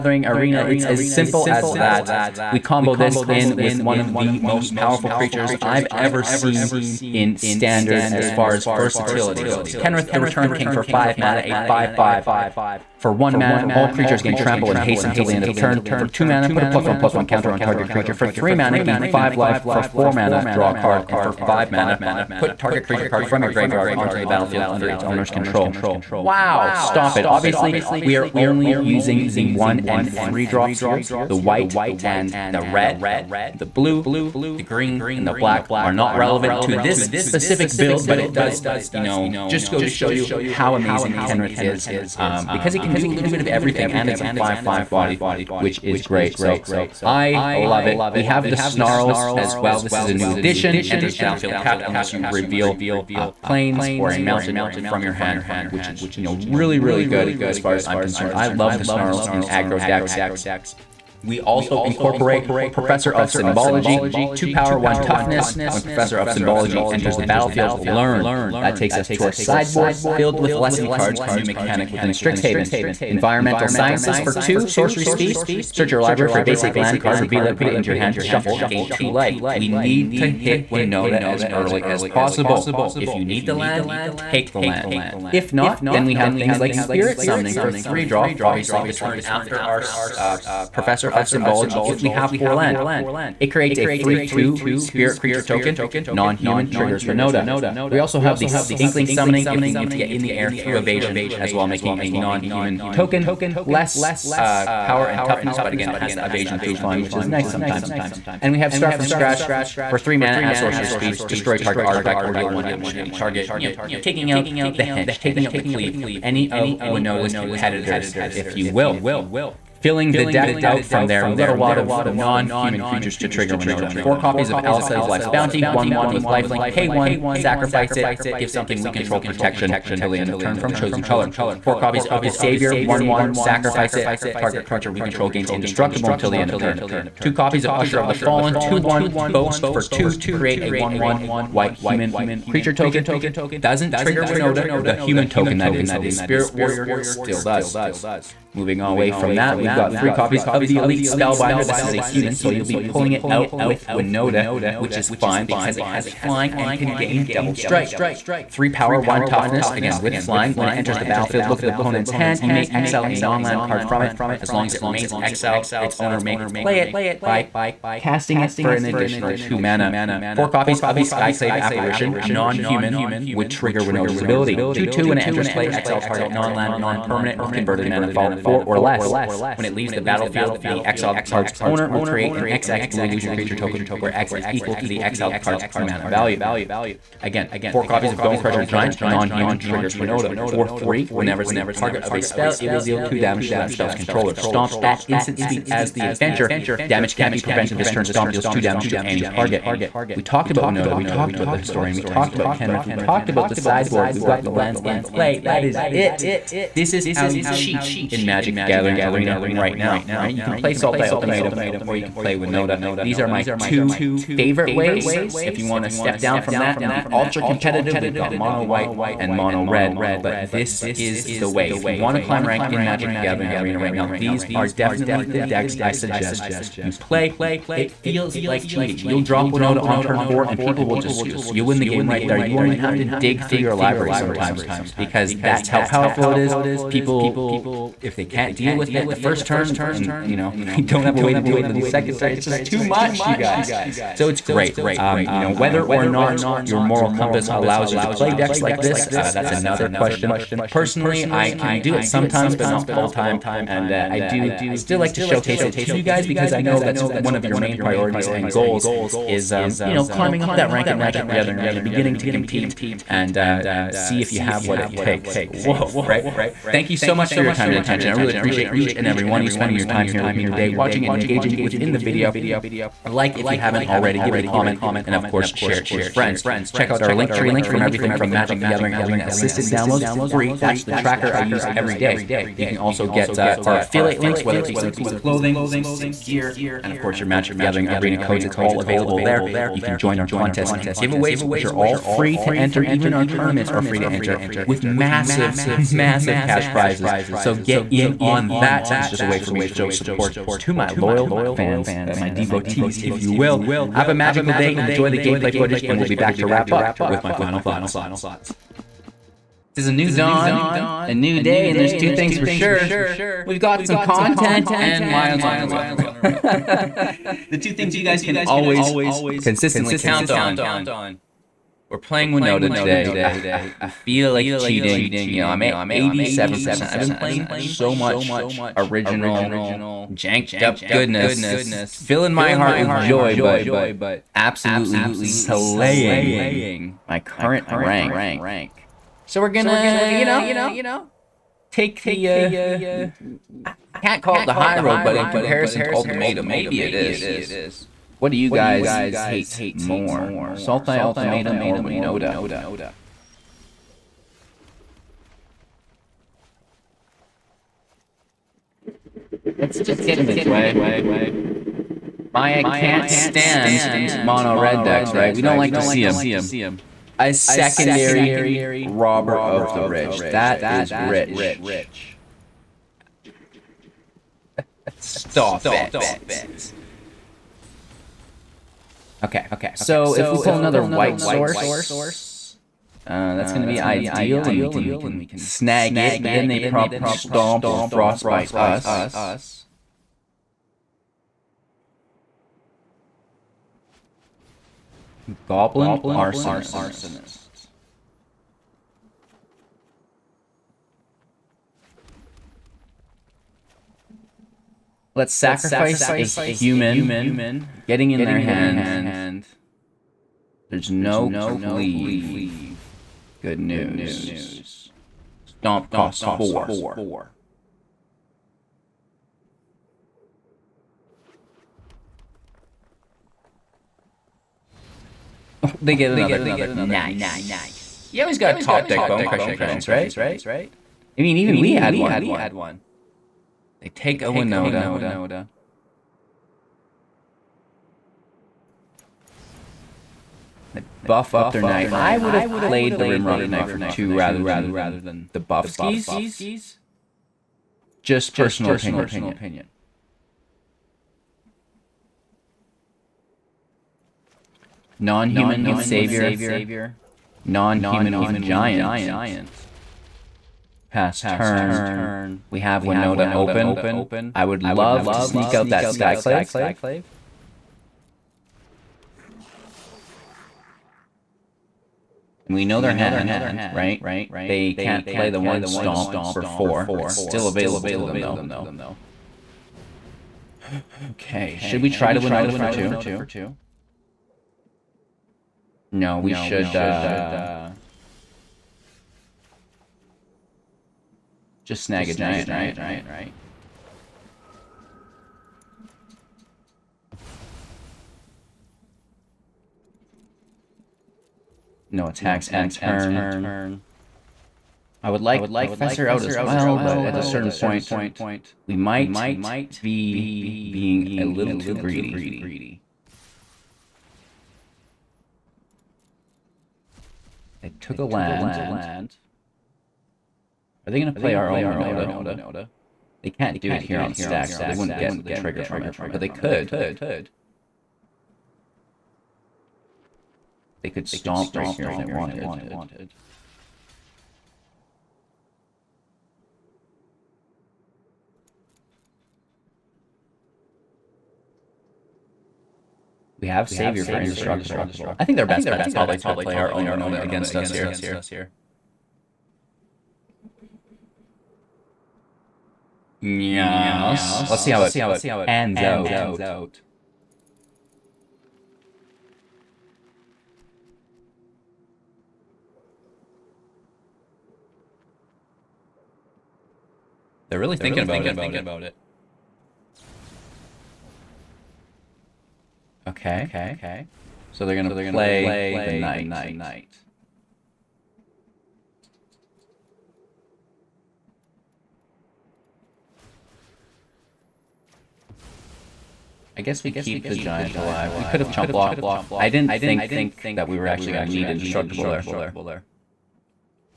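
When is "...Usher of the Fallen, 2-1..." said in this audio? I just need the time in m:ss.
2:17.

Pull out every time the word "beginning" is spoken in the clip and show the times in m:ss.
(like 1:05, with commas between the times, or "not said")
4:21.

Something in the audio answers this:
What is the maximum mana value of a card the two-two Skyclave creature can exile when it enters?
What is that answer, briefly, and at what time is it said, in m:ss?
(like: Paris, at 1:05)
4, at 2:58.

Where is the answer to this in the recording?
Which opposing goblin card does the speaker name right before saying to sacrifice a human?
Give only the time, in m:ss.
6:35.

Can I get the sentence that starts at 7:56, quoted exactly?
It's still available to them, though.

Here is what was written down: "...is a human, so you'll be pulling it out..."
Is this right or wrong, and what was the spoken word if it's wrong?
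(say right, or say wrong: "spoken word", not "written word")
right.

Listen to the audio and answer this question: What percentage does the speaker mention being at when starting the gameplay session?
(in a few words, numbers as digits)
87%.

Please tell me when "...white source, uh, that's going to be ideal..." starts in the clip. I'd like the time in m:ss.
6:20.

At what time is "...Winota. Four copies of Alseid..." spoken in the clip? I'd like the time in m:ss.
2:03.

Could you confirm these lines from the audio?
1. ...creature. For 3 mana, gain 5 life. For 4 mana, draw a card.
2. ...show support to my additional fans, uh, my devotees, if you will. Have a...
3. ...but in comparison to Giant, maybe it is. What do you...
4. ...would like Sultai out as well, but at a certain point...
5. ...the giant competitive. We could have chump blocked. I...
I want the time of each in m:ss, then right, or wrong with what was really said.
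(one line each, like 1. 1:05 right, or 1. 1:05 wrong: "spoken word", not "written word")
1. 0:17 right
2. 4:59 wrong: "loyal", not "additional"
3. 5:45 wrong: "Ultimatum", not "Giant"
4. 8:25 wrong: "Professor", not "Sultai"
5. 9:47 wrong: "alive", not "competitive".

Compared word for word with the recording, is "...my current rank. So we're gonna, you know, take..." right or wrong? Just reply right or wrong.
right.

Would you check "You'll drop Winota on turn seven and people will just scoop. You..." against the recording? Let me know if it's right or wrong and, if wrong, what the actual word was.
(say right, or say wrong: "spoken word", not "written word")
wrong: "four", not "seven".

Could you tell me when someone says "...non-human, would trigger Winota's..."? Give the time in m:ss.
2:52.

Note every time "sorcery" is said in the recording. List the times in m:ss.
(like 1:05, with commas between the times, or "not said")
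1:14, 1:50.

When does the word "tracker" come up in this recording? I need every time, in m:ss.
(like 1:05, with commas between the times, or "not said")
4:40.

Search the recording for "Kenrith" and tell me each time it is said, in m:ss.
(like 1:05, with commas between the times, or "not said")
0:09, 0:41, 3:22.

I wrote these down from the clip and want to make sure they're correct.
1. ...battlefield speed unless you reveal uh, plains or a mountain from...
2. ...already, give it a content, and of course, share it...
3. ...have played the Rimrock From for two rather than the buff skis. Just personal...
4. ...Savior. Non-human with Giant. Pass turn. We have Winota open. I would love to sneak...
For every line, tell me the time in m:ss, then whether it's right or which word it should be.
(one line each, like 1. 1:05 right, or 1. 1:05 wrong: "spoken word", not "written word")
1. 0:51 wrong: "tapped", not "speed"
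2. 4:33 wrong: "comment", not "content"
3. 7:22 wrong: "Knight", not "From"
4. 7:35 right.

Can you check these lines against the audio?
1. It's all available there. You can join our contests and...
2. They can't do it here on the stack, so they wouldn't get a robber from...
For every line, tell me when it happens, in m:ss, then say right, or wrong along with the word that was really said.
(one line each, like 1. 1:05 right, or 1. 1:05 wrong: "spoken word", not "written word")
1. 4:48 right
2. 8:43 wrong: "trigger", not "robber".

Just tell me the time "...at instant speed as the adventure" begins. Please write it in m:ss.
3:14.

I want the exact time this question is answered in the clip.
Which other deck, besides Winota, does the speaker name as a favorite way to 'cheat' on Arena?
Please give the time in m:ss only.
3:30.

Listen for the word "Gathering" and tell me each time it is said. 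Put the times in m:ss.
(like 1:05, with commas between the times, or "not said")
3:28, 3:43, 4:21, 4:38, 4:47.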